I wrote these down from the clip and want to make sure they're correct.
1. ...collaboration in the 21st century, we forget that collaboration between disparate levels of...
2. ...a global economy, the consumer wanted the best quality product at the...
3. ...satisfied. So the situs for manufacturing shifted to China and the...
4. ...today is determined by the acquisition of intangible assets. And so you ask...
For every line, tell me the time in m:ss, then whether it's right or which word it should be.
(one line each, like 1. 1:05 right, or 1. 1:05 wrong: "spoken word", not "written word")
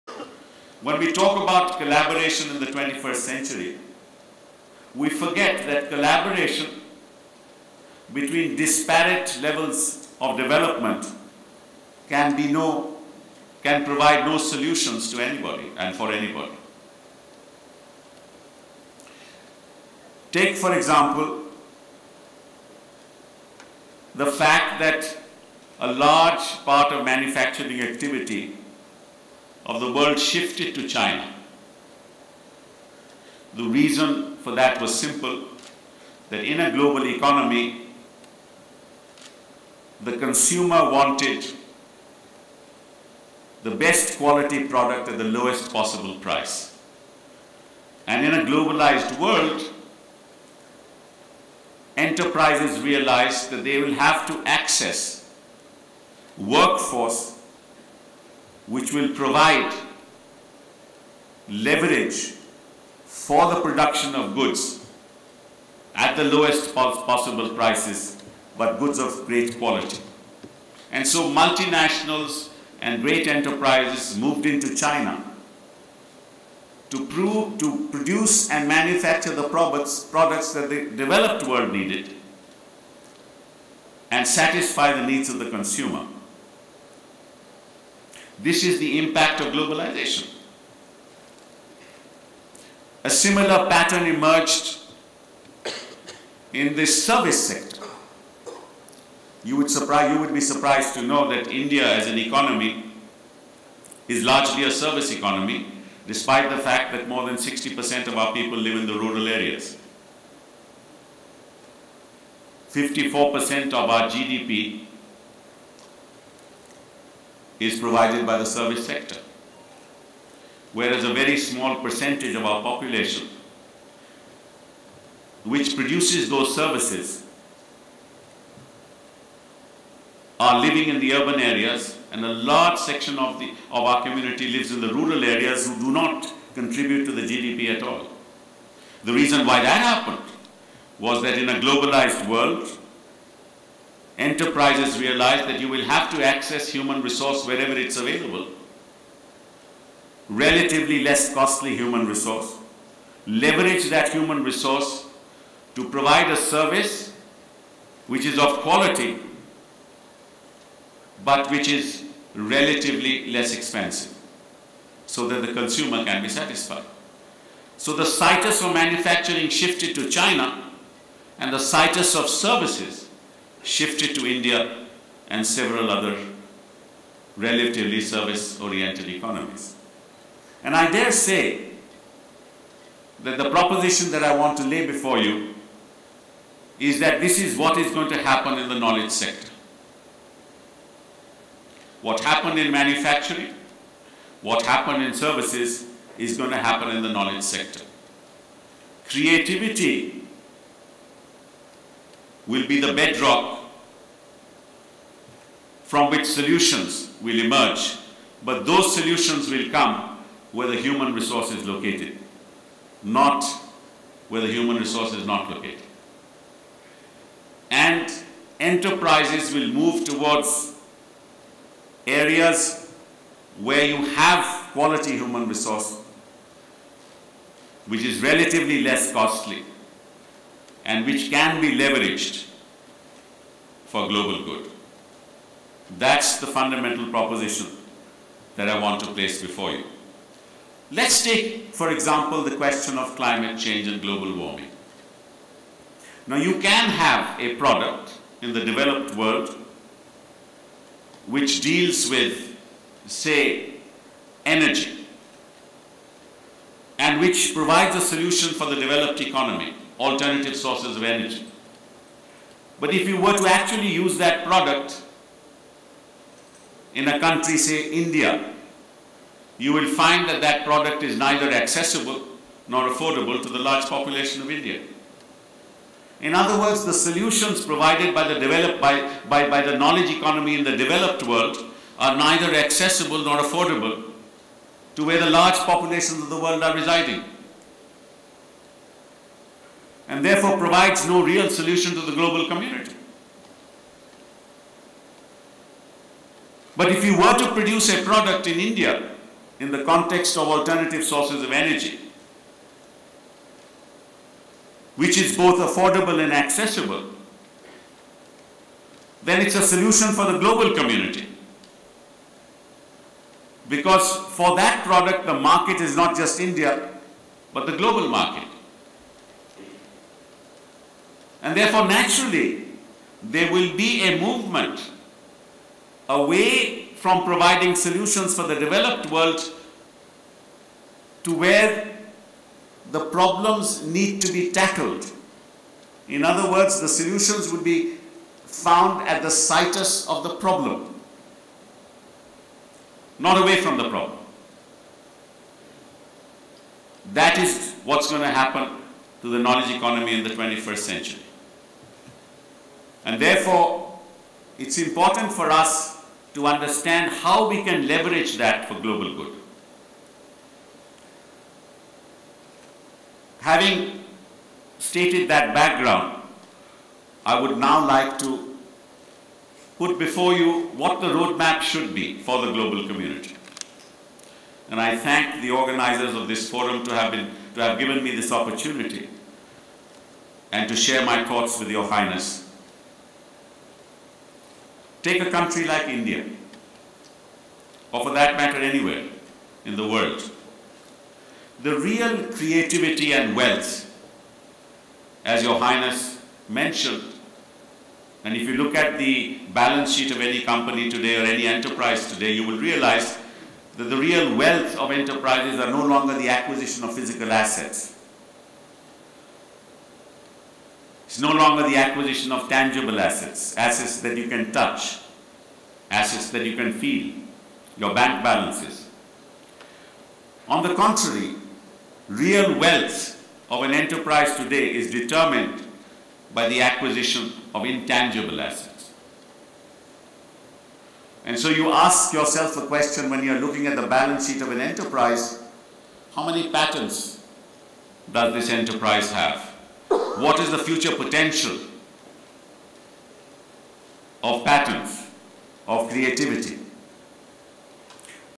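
1. 0:01 right
2. 0:36 right
3. 2:46 right
4. 7:04 right.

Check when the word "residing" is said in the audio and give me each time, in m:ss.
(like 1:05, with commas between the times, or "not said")
4:46.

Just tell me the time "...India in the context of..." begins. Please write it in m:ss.
4:58.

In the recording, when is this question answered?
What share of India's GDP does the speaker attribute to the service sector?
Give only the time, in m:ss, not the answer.
1:52.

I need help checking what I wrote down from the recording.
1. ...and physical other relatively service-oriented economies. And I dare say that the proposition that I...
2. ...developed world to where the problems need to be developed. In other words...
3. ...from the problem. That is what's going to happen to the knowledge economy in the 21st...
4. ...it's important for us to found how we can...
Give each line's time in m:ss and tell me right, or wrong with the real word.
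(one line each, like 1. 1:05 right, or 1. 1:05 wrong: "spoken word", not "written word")
1. 2:55 wrong: "several", not "physical"
2. 5:28 wrong: "tackled", not "developed"
3. 5:43 right
4. 5:54 wrong: "understand", not "found".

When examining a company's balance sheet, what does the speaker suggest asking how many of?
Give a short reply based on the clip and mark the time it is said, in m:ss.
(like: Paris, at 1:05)
patents, at 7:16.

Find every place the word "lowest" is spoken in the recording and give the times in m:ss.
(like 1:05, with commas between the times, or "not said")
0:45, 1:06.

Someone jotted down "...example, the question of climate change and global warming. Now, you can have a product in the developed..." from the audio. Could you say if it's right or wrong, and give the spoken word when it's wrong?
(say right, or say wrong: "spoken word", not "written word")
right.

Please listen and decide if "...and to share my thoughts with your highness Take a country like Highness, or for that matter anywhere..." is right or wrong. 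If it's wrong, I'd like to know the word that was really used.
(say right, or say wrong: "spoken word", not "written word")
wrong: "India", not "Highness".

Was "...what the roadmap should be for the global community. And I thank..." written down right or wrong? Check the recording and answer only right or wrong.
right.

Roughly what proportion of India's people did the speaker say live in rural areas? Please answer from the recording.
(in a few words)
more than 60%.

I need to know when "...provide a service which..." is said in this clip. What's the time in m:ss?
2:35.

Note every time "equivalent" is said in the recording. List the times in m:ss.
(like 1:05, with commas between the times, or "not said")
not said.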